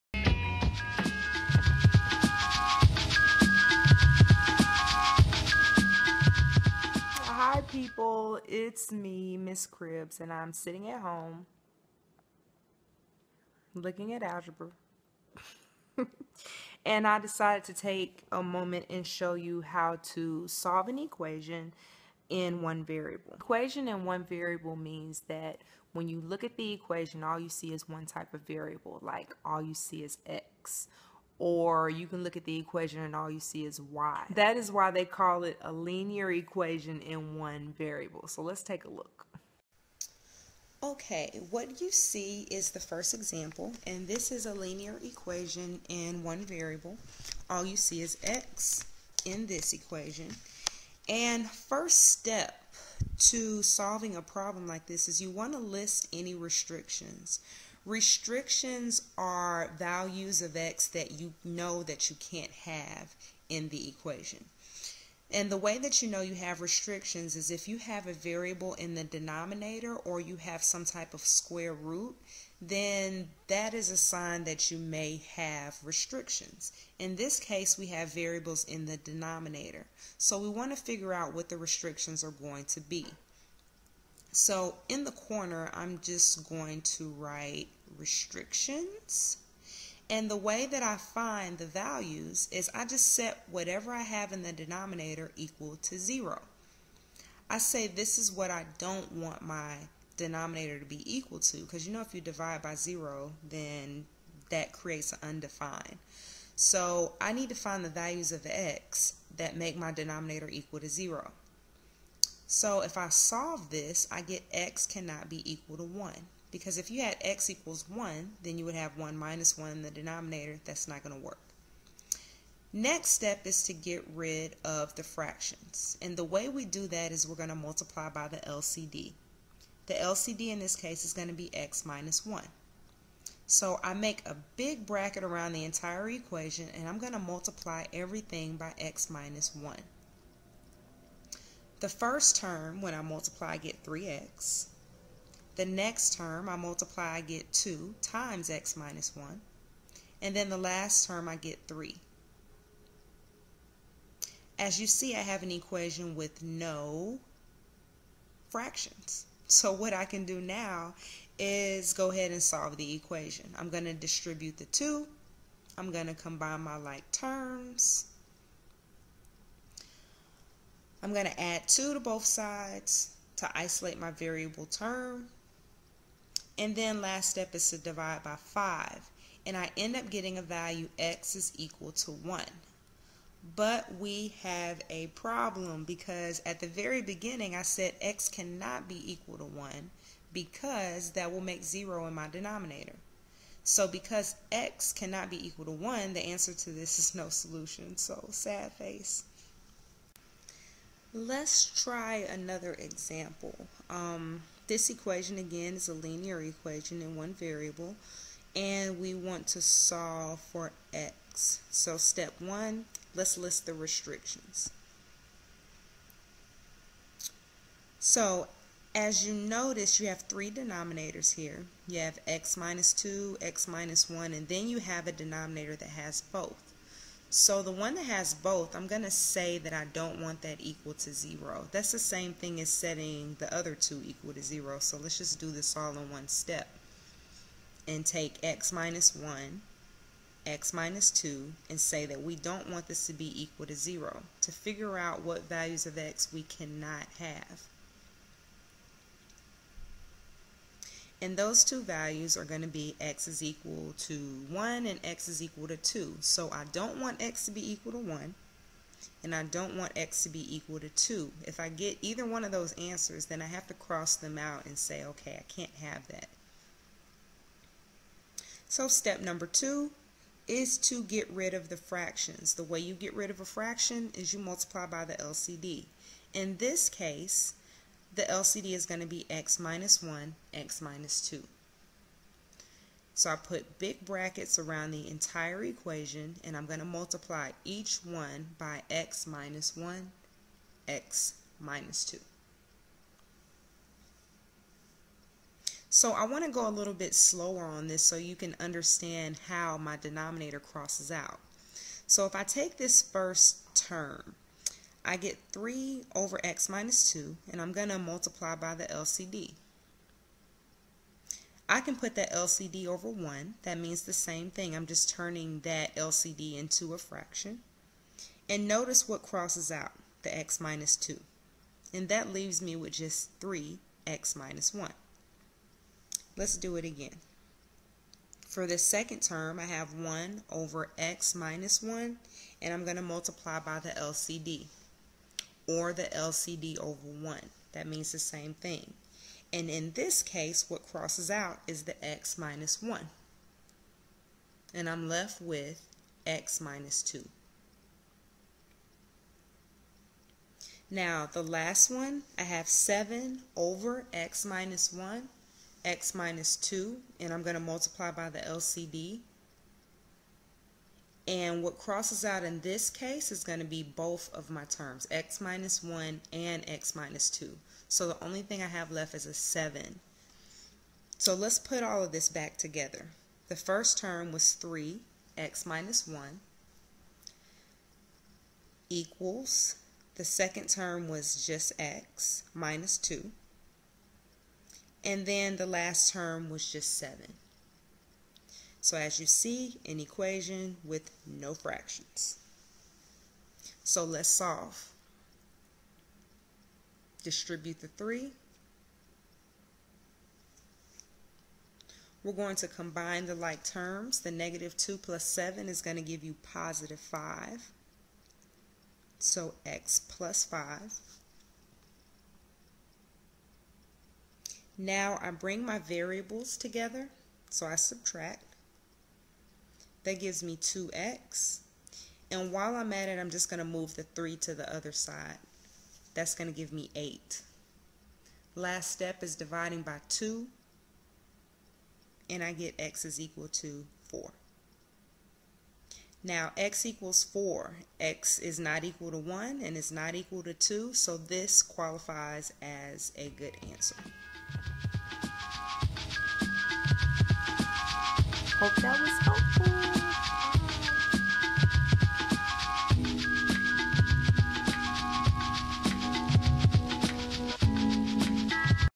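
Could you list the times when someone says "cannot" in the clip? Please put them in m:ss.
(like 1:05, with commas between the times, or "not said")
1:54, 3:08, 3:14, 4:06.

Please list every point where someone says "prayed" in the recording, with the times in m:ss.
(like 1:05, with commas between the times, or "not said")
not said.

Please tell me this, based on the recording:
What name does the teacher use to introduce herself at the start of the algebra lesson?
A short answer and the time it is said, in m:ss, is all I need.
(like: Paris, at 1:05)
Miss Cribs, at 0:09.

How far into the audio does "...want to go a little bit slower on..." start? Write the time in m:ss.
4:56.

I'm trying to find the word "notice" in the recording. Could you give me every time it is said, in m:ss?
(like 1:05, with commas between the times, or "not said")
3:39, 5:18.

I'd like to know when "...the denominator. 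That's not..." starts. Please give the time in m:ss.
1:59.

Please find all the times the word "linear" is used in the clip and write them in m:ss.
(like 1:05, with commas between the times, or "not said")
0:35, 0:44, 3:25.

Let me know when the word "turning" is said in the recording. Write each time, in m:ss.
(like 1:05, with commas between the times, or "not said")
5:15.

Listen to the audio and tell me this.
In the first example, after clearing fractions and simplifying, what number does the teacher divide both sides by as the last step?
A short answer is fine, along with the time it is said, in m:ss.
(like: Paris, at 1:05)
5, at 2:57.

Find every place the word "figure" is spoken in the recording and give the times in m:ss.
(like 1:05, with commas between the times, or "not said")
1:20, 4:04.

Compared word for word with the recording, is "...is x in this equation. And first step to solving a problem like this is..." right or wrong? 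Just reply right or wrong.
right.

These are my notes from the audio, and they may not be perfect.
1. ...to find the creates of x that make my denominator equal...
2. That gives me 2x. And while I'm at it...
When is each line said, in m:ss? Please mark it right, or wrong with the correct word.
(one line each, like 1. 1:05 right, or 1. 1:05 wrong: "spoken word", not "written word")
1. 1:47 wrong: "values", not "creates"
2. 7:00 right.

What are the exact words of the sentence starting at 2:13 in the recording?
So I make a big bracket around the entire equation and I'm going to multiply everything by x minus 1.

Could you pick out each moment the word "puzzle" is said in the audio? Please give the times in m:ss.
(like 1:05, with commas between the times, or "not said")
not said.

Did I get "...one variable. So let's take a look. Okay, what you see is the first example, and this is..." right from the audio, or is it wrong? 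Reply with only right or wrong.
right.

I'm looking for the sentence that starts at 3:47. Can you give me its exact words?
So the one that has both, I'm going to say that I don't want that equal to 0.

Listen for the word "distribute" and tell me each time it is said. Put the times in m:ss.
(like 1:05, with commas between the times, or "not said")
2:43, 6:37.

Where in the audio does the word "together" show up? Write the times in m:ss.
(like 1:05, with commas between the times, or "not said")
6:12, 6:56.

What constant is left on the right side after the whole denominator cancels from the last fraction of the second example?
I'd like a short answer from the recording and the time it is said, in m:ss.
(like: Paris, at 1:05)
7, at 6:09.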